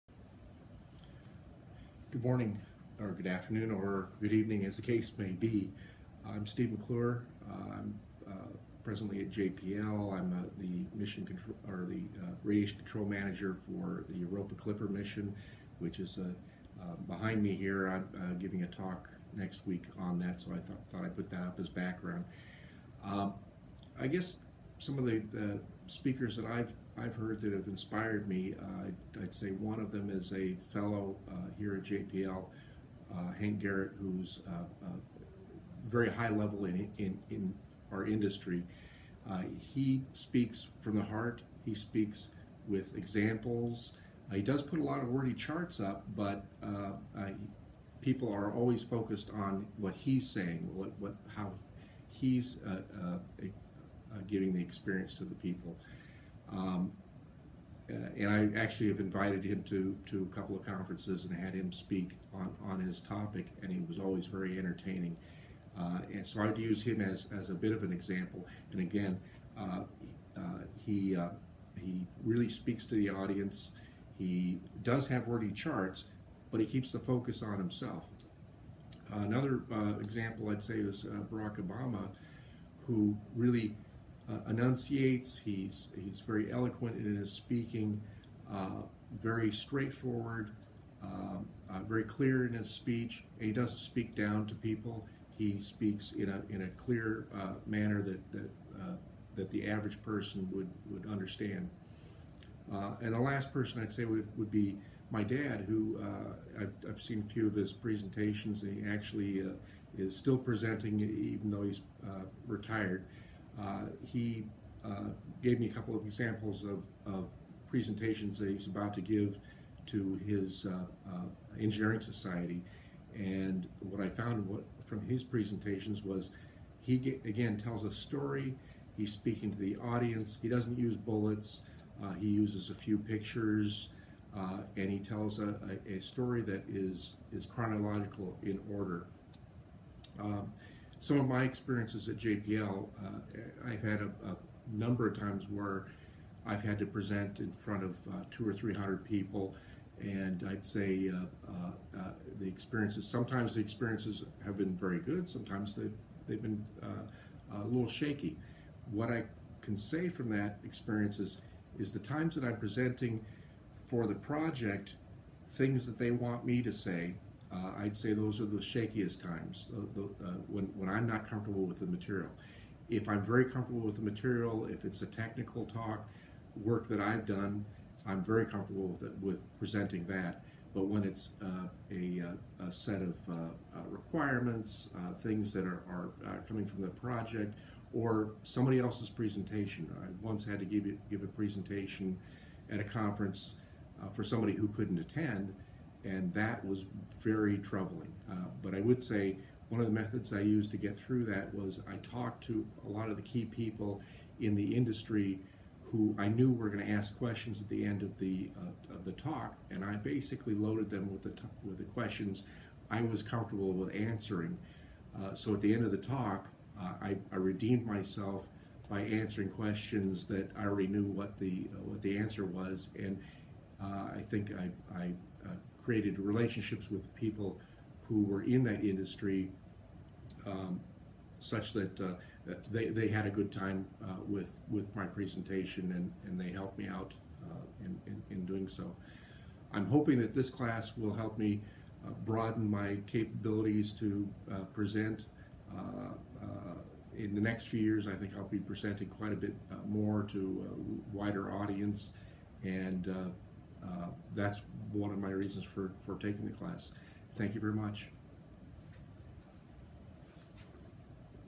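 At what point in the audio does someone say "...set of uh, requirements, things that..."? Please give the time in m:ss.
3:02.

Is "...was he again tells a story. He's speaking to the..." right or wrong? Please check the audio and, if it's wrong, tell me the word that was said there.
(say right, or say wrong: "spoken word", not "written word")
right.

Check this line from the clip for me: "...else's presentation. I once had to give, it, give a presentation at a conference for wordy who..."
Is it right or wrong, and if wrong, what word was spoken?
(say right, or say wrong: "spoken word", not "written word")
wrong: "somebody", not "wordy".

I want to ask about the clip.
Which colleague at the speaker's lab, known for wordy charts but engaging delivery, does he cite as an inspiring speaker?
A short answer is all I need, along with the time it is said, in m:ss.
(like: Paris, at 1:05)
Hank Garrett, at 0:33.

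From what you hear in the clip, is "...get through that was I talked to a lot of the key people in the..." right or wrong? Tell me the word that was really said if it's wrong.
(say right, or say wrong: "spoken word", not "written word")
right.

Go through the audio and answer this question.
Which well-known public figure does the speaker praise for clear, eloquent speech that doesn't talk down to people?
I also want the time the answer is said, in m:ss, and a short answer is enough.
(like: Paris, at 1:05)
Barack Obama, at 1:21.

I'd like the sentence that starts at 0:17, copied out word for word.
I'm giving a talk next week on that, so I th thought I'd put that up as background.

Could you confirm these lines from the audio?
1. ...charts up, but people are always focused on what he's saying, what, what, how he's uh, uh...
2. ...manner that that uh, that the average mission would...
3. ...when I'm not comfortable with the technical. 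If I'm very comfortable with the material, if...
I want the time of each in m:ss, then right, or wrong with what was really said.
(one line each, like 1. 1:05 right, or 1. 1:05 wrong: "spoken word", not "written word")
1. 0:45 right
2. 1:37 wrong: "person", not "mission"
3. 2:50 wrong: "material", not "technical".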